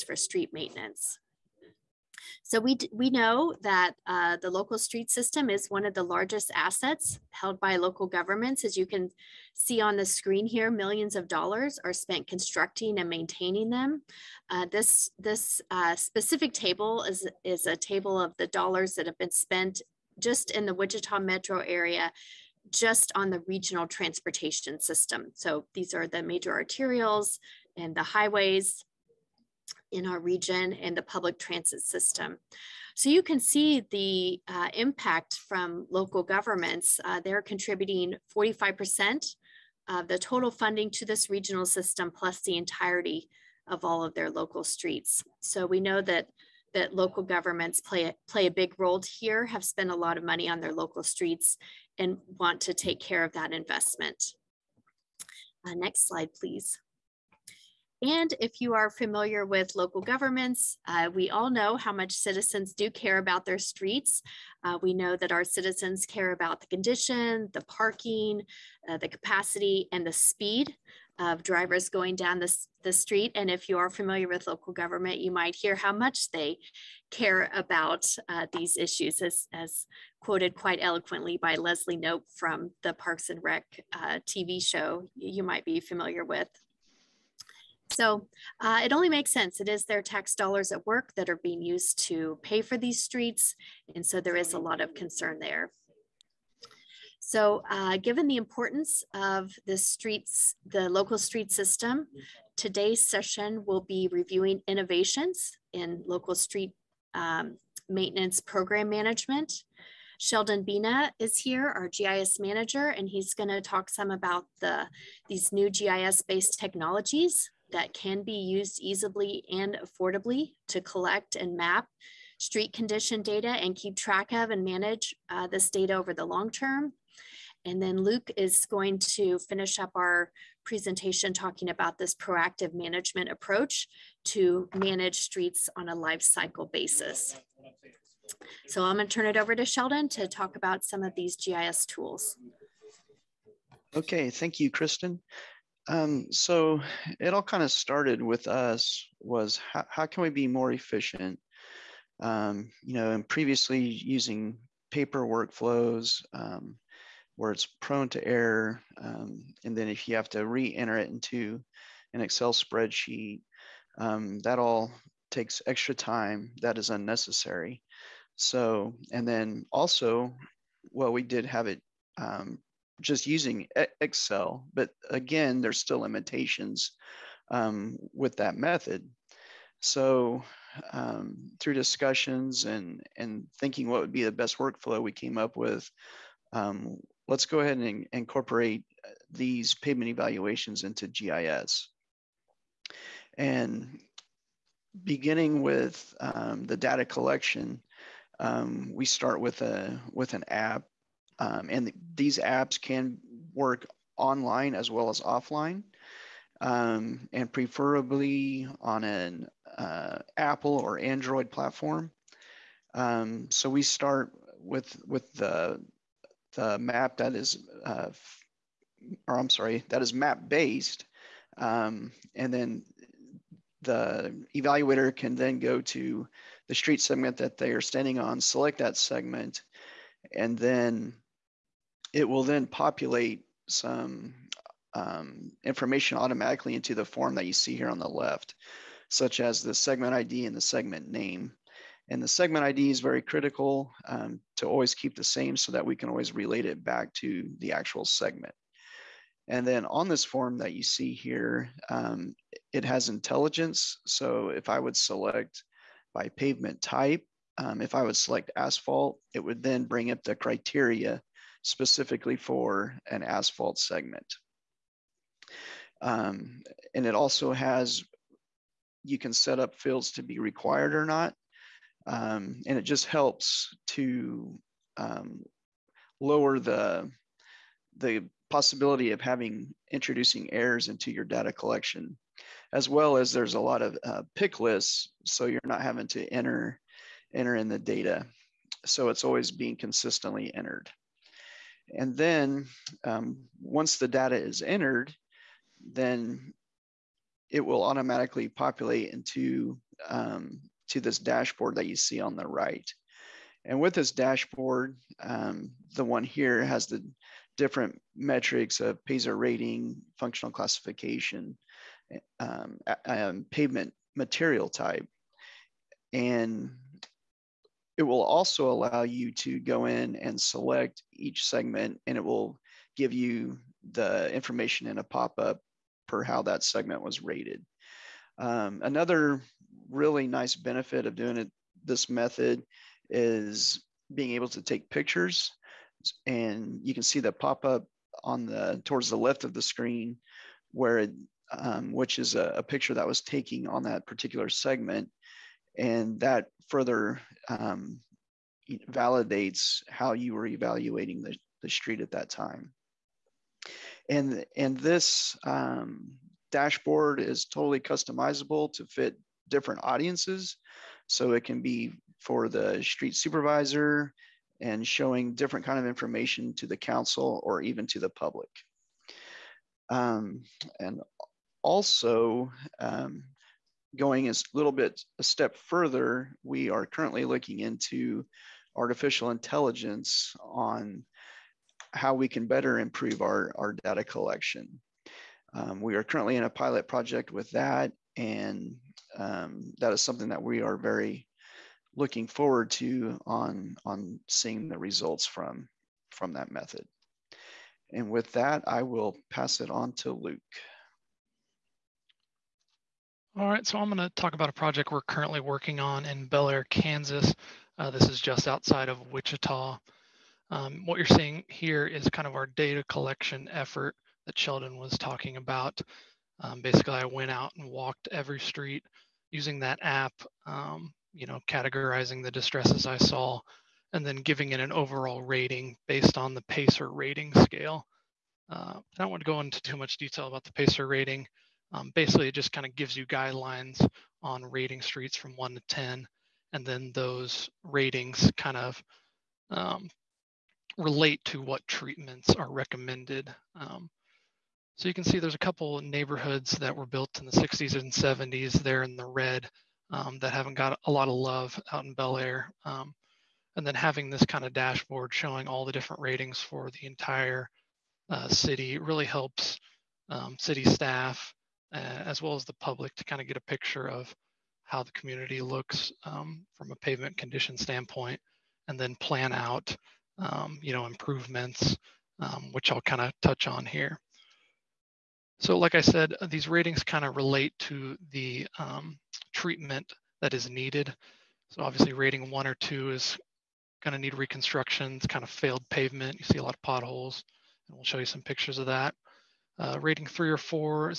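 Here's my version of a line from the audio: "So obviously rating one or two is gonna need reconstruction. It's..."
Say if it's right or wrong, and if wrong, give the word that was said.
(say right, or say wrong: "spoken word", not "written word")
right.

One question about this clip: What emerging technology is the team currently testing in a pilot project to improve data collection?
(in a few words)
Artificial intelligence.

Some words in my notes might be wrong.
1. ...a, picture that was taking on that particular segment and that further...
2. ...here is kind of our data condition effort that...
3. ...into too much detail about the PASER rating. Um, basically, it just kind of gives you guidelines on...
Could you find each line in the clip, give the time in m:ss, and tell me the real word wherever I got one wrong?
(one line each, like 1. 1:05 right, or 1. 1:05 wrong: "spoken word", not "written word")
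1. 5:42 right
2. 6:51 wrong: "collection", not "condition"
3. 7:09 right.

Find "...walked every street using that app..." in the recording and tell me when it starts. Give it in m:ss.
6:57.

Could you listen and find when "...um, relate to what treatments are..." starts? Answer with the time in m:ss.
7:19.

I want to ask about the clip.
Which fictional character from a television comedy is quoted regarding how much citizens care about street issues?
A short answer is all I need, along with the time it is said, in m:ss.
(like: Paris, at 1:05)
Leslie Knope, at 1:21.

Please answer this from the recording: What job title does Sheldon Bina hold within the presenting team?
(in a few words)
GIS manager.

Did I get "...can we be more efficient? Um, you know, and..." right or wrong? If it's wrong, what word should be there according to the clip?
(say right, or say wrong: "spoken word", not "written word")
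right.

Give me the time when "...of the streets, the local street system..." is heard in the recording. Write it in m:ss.
1:39.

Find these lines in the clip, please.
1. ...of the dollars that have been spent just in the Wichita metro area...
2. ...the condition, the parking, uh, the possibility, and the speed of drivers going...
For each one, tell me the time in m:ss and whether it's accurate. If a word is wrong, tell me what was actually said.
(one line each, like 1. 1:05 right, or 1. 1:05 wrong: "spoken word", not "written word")
1. 0:18 right
2. 1:06 wrong: "capacity", not "possibility".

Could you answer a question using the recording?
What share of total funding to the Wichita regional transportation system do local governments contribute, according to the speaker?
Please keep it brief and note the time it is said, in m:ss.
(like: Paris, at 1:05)
45%, at 0:38.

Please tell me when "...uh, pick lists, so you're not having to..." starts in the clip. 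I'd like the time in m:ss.
4:44.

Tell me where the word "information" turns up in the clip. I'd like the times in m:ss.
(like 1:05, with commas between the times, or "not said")
3:55, 5:24, 6:05.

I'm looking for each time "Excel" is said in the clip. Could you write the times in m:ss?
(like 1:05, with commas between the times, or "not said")
2:42, 2:53.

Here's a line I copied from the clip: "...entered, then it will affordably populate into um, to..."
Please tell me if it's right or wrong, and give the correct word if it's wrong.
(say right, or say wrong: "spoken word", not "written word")
wrong: "automatically", not "affordably".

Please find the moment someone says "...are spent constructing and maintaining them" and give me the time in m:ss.
0:11.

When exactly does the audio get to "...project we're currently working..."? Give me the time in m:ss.
6:44.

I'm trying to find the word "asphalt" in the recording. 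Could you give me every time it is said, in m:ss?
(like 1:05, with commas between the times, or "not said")
4:18, 4:23.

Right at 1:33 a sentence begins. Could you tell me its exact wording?
And so there is a lot of concern there.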